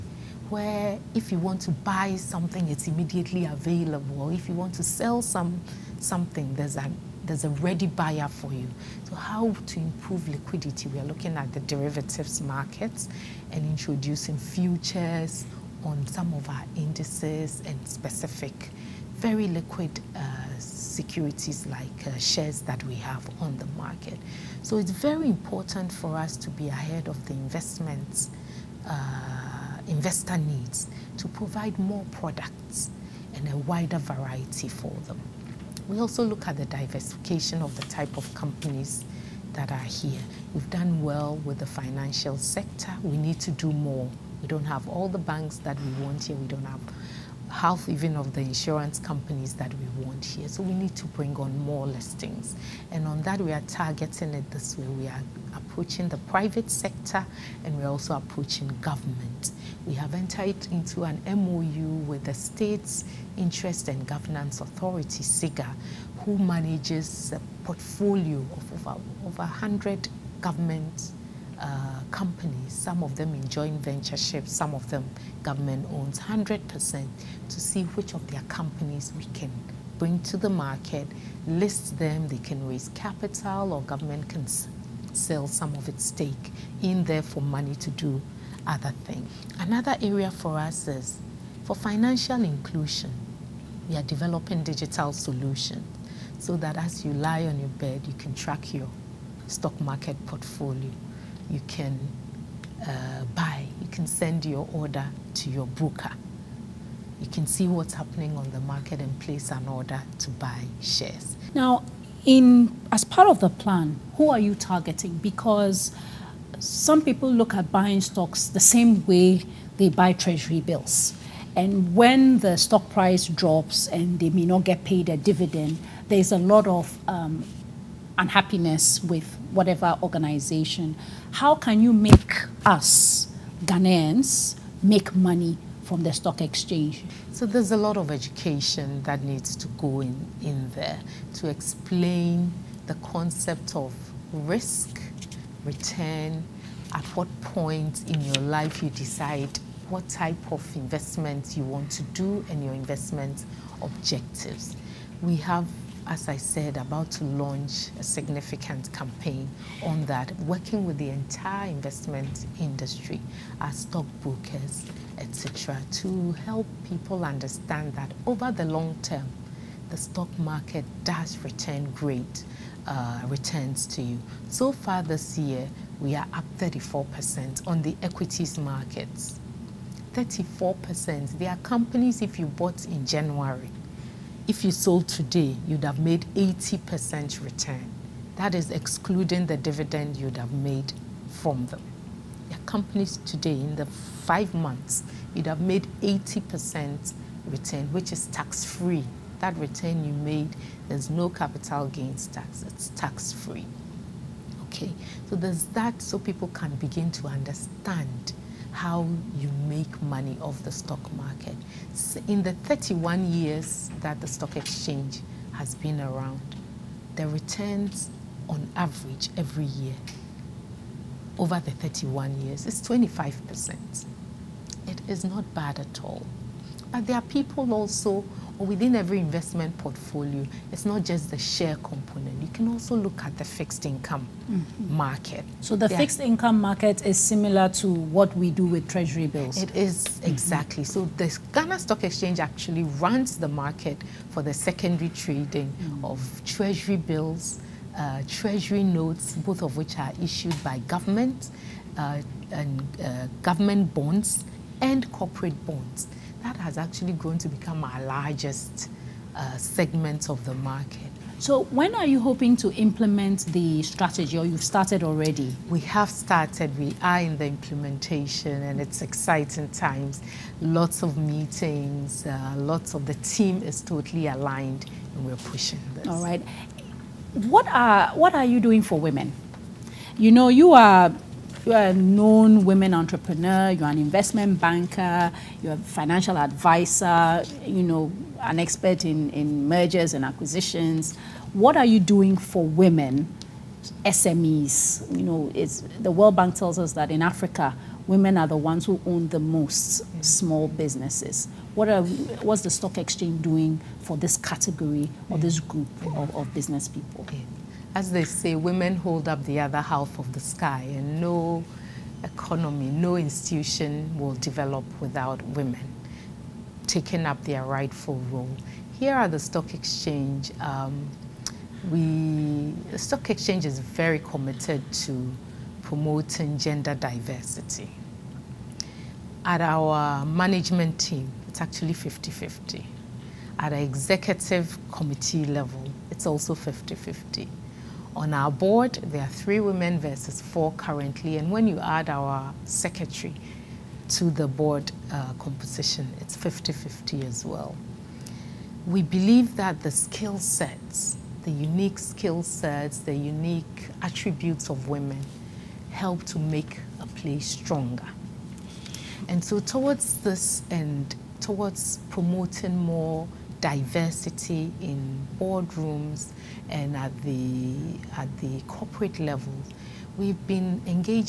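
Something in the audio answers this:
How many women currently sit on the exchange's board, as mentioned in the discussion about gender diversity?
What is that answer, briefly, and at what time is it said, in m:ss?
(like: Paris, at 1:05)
3, at 5:39.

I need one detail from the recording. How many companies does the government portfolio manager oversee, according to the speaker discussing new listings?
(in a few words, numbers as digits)
over 100.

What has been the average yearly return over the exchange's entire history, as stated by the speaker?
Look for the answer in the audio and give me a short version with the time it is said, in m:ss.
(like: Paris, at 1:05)
25%, at 3:42.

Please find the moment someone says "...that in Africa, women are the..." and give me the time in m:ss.
4:56.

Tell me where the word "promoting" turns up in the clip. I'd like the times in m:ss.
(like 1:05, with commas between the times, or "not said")
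5:25, 6:02.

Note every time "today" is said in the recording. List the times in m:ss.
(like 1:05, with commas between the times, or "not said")
3:05, 3:13.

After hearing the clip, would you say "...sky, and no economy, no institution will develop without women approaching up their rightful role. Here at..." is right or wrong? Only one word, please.
wrong.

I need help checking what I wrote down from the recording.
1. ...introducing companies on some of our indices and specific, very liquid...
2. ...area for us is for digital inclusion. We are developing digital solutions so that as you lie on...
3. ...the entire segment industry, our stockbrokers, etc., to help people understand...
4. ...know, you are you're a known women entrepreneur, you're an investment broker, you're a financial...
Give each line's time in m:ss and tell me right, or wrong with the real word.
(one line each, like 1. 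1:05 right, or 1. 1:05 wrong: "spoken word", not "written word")
1. 0:13 wrong: "futures", not "companies"
2. 1:30 wrong: "financial", not "digital"
3. 2:40 wrong: "investment", not "segment"
4. 4:40 wrong: "banker", not "broker".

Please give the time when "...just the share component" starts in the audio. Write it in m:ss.
3:51.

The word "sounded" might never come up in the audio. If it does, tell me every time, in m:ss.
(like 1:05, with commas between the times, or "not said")
not said.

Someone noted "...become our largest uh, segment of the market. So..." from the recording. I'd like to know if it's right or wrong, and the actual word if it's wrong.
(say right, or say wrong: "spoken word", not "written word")
right.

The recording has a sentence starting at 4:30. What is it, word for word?
Lots of meetings, uh, lots of the team is totally aligned and we're pushing this.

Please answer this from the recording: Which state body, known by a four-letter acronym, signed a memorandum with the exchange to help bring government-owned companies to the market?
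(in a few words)
SIGA.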